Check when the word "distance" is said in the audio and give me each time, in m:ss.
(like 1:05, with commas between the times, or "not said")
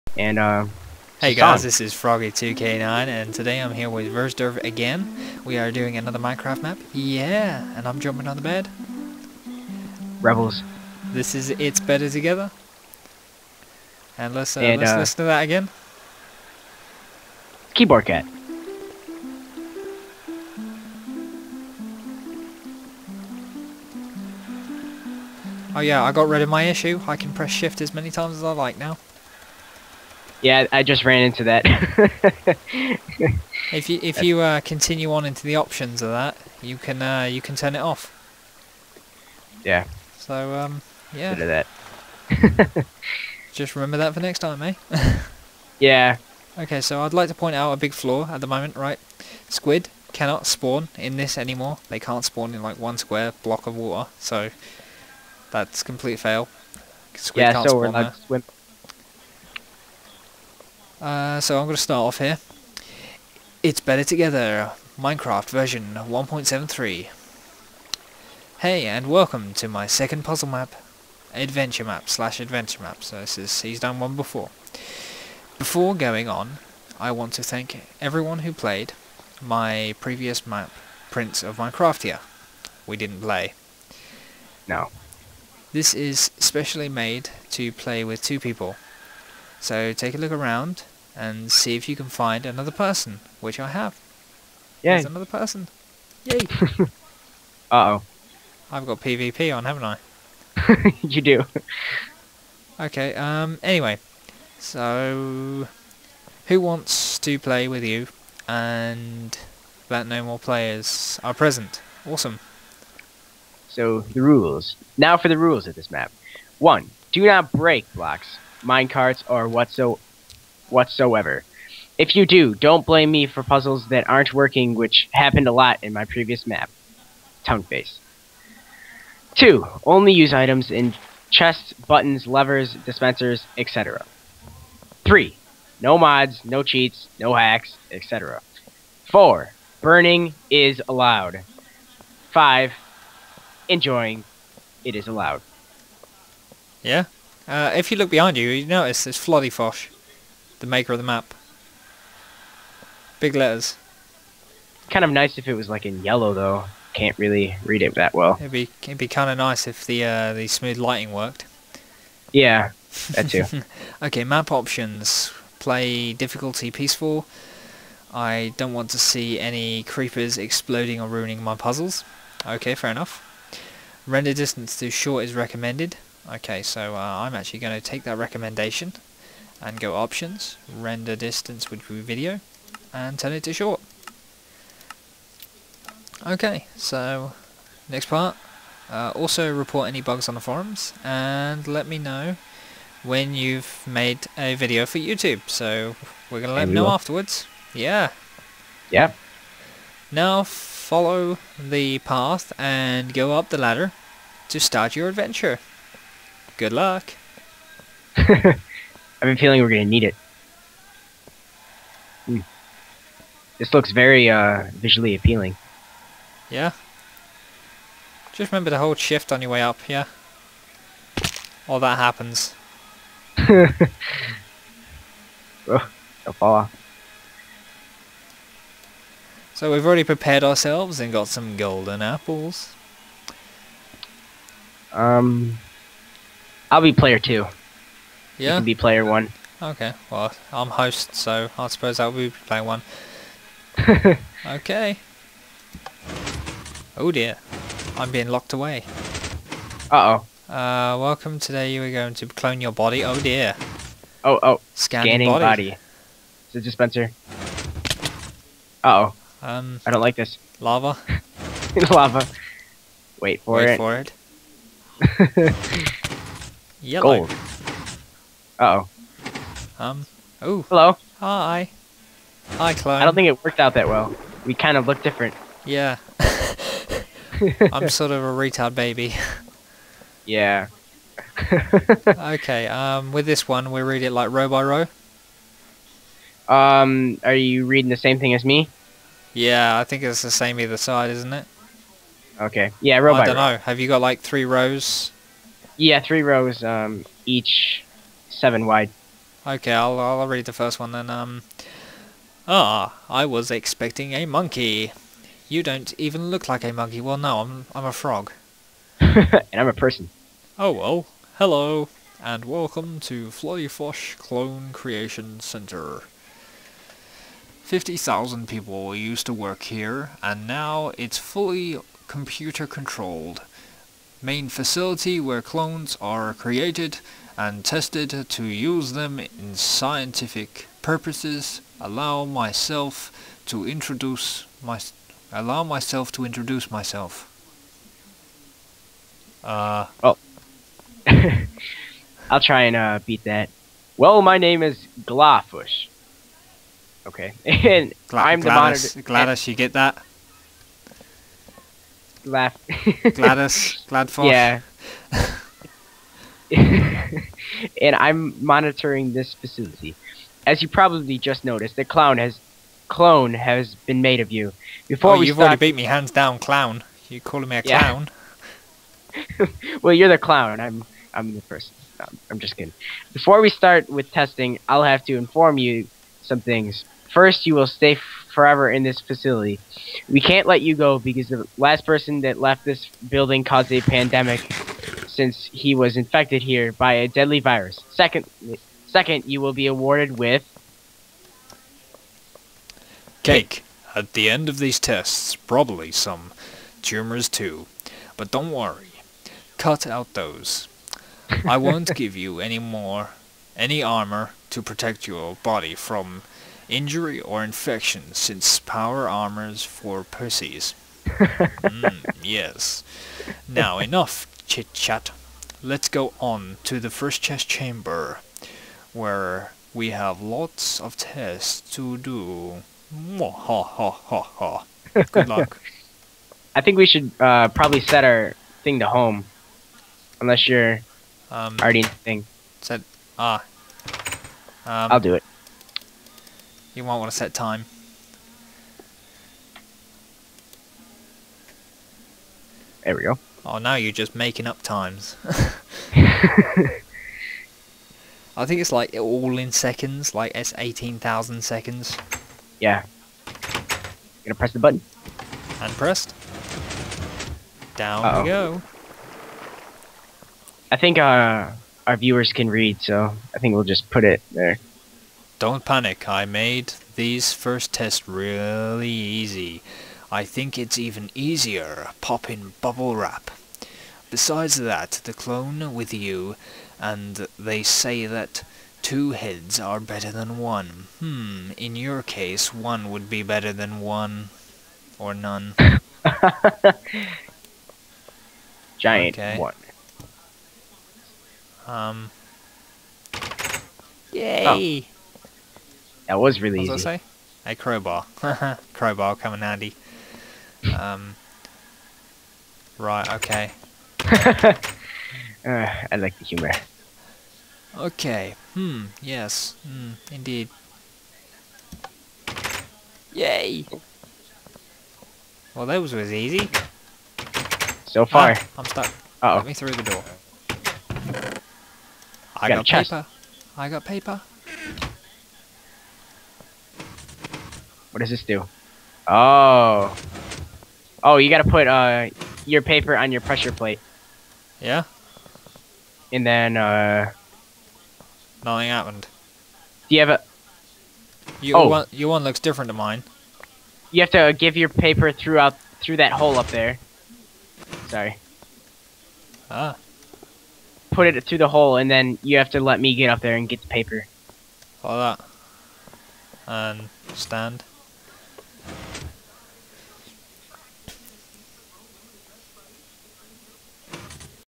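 2:54, 3:01.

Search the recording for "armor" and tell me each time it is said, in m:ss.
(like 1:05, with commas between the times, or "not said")
6:43, 6:49.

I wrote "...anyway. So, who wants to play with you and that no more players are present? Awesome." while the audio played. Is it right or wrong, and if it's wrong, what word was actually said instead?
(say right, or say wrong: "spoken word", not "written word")
right.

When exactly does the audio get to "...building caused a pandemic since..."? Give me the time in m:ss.
6:23.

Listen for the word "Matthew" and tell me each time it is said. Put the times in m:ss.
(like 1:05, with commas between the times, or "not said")
not said.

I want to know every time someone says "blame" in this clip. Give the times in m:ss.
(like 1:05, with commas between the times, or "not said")
2:02.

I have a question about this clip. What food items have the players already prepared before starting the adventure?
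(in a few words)
Golden apples.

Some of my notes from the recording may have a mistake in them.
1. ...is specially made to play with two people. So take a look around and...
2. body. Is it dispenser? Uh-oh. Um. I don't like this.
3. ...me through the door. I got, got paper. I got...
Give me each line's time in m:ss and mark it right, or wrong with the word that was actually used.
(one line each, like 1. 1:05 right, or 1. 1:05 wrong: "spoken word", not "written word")
1. 1:25 right
2. 4:15 right
3. 8:39 right.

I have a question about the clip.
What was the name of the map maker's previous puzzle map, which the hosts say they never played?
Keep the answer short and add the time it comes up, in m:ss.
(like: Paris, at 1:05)
Prince of Minecraft, at 1:21.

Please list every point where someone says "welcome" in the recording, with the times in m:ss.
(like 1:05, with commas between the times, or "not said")
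1:09, 4:10, 5:12.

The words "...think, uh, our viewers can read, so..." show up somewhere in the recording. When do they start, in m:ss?
7:40.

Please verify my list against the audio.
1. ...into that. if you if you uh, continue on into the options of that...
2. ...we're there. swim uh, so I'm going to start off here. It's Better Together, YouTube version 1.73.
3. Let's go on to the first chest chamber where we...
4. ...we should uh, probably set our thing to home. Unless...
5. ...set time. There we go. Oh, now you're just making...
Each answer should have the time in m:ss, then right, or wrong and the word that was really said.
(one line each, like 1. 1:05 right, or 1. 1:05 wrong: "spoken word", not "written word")
1. 0:31 right
2. 0:57 wrong: "Minecraft", not "YouTube"
3. 6:55 right
4. 7:06 right
5. 7:17 right.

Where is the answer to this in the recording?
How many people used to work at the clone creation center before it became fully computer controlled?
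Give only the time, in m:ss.
5:17.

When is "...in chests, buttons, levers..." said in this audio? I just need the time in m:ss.
2:10.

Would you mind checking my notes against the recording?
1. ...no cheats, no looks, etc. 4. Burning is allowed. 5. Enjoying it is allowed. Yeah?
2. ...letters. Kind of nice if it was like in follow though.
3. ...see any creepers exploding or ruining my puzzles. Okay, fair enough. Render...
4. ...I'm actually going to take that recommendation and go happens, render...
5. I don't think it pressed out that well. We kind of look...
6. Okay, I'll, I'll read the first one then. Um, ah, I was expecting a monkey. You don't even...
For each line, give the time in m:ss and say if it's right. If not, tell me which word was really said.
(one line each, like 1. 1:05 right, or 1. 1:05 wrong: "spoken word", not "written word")
1. 2:16 wrong: "hacks", not "looks"
2. 2:33 wrong: "yellow", not "follow"
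3. 2:48 right
4. 2:57 wrong: "options", not "happens"
5. 4:33 wrong: "worked", not "pressed"
6. 4:59 right.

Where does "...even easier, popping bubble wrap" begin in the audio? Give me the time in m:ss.
7:50.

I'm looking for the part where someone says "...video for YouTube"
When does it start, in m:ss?
3:14.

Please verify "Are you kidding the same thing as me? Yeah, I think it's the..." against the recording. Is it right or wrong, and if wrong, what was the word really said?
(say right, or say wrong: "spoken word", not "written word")
wrong: "reading", not "kidding".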